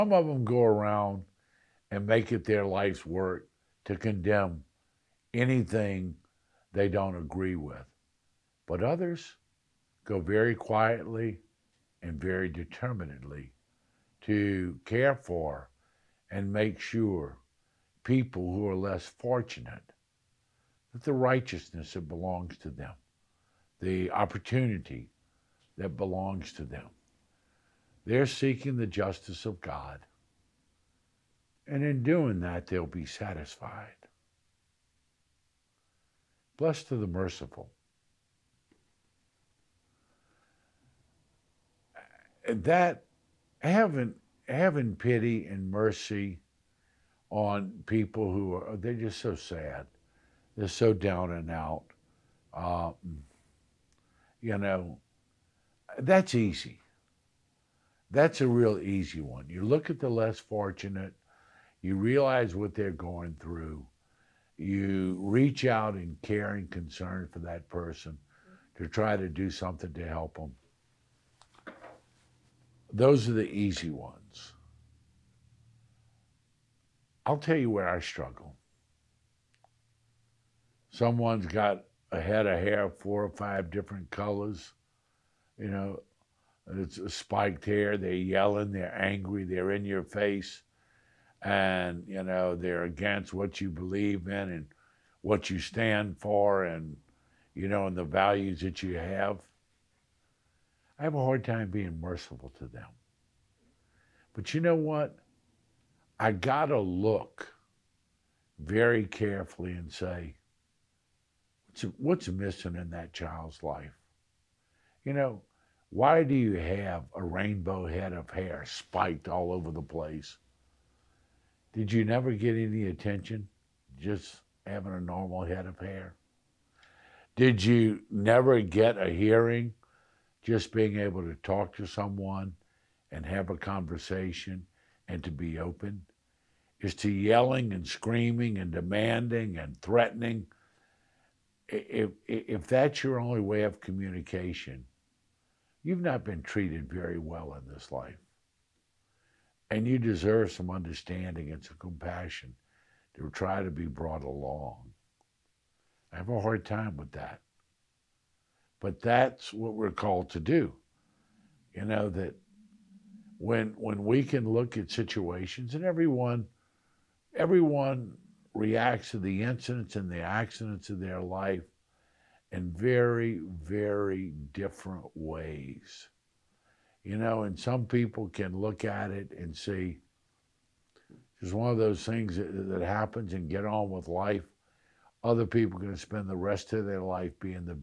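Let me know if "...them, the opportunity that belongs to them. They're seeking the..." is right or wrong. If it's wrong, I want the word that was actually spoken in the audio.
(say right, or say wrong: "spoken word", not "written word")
right.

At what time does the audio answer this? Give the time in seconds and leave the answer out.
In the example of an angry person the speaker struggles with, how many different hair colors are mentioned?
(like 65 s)
82 s.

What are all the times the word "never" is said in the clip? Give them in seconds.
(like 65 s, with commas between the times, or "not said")
122 s, 128 s.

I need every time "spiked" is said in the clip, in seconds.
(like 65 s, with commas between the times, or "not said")
87 s, 118 s.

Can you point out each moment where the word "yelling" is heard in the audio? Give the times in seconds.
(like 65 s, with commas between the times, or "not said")
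88 s, 137 s.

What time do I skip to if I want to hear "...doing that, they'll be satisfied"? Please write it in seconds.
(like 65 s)
32 s.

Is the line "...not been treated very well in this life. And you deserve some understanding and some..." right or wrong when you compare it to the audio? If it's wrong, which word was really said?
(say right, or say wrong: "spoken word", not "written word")
right.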